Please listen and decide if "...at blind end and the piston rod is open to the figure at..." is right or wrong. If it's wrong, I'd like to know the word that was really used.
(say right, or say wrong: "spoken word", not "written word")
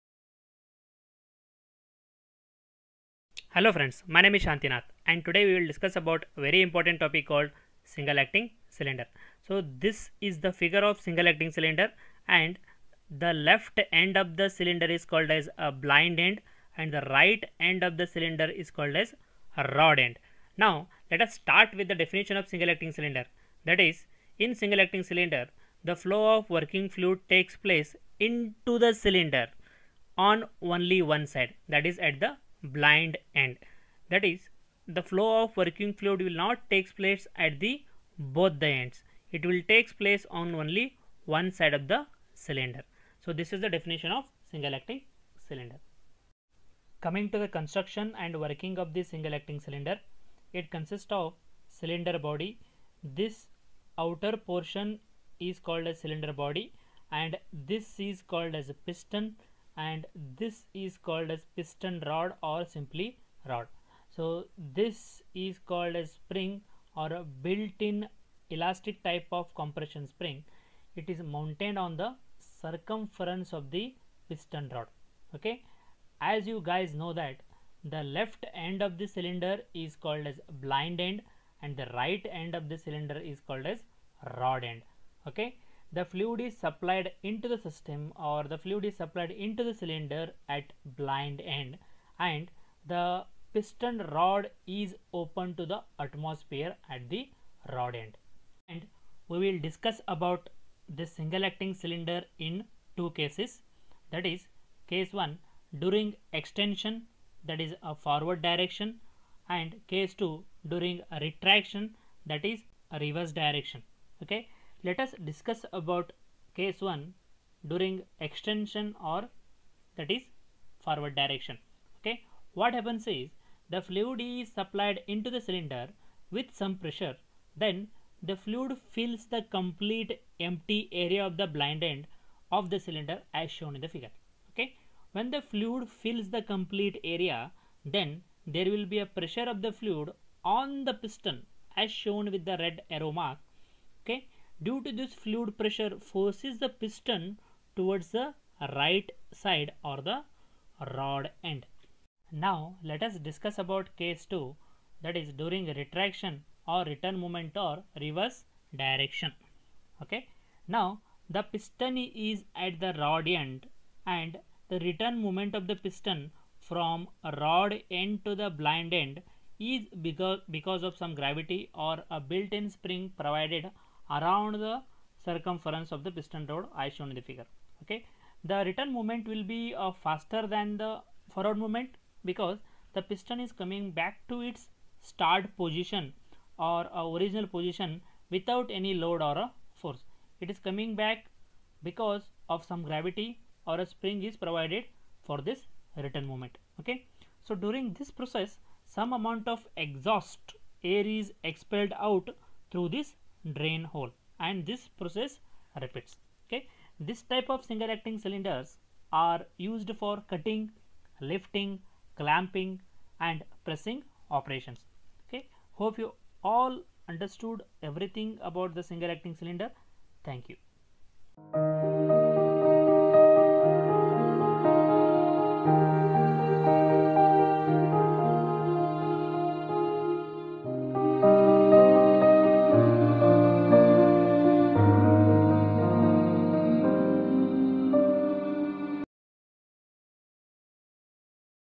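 wrong: "atmosphere", not "figure".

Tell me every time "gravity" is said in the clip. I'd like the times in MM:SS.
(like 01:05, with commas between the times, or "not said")
02:51, 03:12.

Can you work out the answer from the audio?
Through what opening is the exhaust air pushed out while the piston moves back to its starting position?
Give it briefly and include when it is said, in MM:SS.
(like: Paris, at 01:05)
Drain hole, at 03:23.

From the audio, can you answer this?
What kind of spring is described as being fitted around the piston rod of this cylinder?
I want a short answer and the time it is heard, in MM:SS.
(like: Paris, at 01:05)
Compression spring, at 01:09.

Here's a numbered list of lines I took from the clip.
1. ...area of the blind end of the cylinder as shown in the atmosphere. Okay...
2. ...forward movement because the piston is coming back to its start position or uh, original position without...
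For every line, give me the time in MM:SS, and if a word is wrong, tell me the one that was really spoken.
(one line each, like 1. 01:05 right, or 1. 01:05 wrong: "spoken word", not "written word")
1. 02:10 wrong: "figure", not "atmosphere"
2. 03:01 right.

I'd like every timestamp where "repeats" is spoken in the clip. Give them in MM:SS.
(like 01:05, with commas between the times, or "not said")
03:25.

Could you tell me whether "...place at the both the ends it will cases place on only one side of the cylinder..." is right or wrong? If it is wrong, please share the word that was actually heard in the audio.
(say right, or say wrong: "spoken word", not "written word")
wrong: "takes", not "cases".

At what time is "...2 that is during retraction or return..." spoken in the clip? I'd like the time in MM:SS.
02:34.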